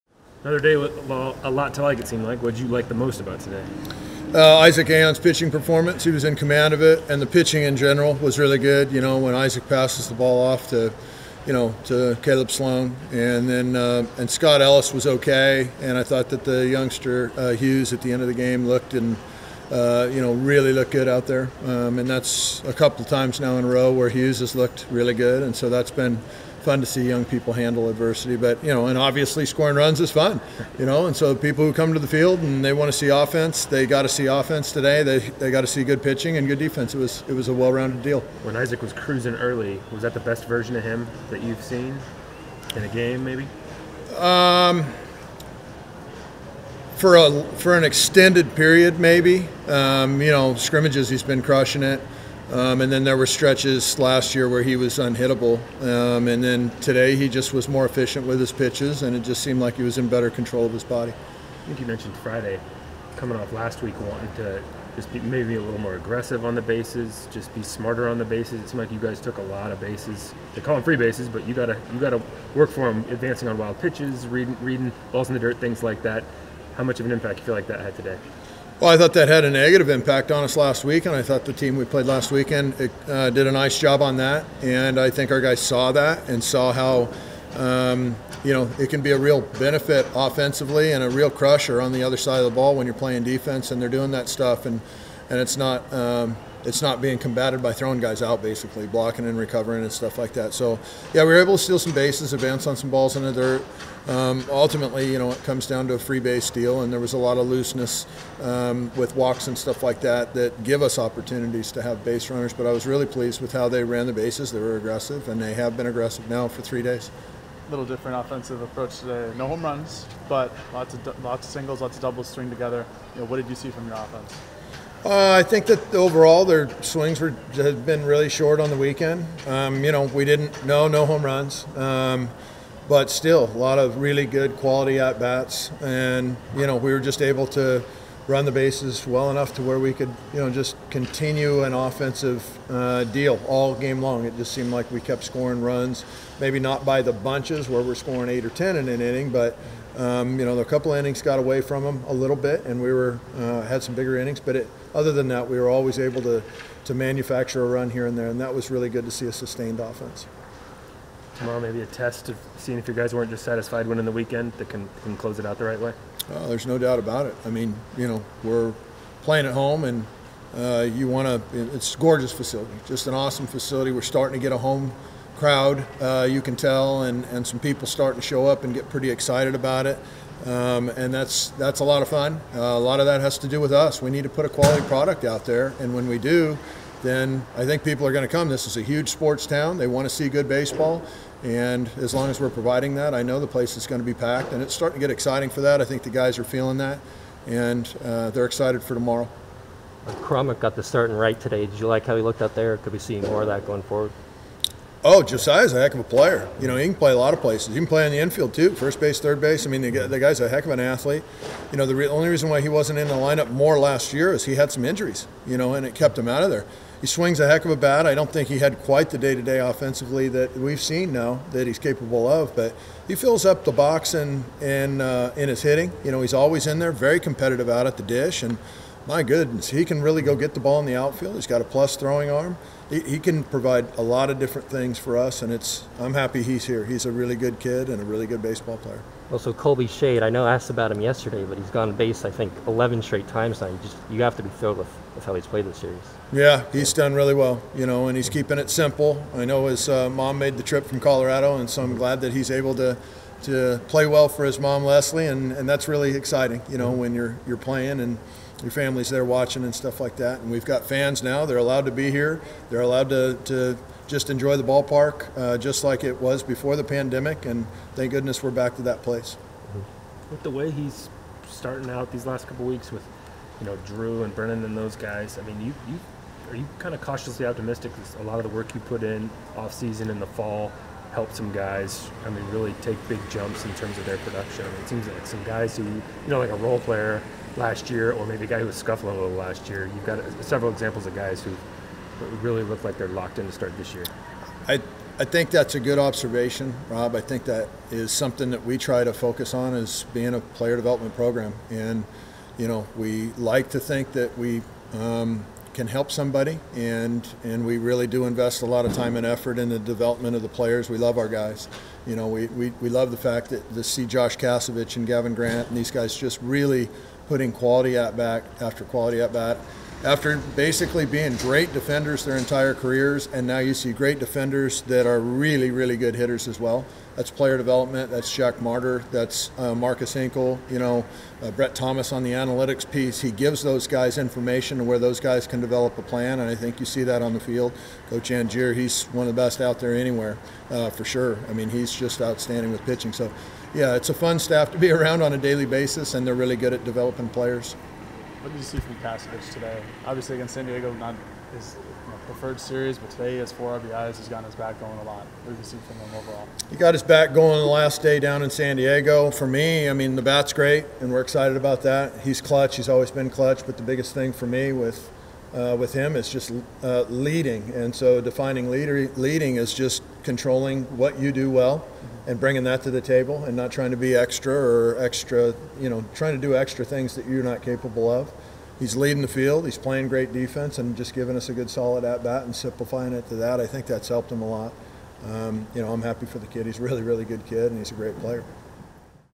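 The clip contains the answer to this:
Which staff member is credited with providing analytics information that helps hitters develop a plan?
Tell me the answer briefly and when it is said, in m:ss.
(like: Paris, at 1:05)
Brett Thomas, at 5:31.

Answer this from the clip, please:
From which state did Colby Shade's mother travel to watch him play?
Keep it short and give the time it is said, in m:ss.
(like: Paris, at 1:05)
Colorado, at 4:10.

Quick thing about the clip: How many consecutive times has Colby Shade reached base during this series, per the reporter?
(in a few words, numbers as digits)
11.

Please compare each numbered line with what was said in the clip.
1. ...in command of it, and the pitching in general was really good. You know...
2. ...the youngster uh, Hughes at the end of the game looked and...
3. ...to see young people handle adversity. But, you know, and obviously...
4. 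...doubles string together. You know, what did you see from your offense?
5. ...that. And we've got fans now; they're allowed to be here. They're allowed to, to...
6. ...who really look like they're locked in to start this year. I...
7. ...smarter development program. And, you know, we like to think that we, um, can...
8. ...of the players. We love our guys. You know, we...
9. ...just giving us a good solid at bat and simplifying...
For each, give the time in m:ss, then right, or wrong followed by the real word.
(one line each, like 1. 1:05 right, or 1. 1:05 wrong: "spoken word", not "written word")
1. 0:06 right
2. 0:16 right
3. 0:26 right
4. 2:02 right
5. 4:20 right
6. 4:51 right
7. 5:00 wrong: "player", not "smarter"
8. 5:10 right
9. 6:20 right.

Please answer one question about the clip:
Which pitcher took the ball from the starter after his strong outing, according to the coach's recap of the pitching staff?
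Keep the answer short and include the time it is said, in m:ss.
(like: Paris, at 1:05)
Caleb Sloan, at 0:12.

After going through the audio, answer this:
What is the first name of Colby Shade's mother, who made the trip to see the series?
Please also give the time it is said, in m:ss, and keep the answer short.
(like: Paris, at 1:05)
Leslie, at 4:14.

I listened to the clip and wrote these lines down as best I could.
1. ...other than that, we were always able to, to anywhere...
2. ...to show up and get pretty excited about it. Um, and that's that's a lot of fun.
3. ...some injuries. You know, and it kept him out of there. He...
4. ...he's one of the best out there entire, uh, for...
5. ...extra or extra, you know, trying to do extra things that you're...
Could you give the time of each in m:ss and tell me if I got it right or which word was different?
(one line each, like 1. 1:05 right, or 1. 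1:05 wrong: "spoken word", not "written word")
1. 2:34 wrong: "manufacture", not "anywhere"
2. 2:58 right
3. 3:34 right
4. 5:38 wrong: "anywhere", not "entire"
5. 6:14 right.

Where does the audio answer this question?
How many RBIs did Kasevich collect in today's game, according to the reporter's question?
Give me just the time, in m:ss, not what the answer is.
5:53.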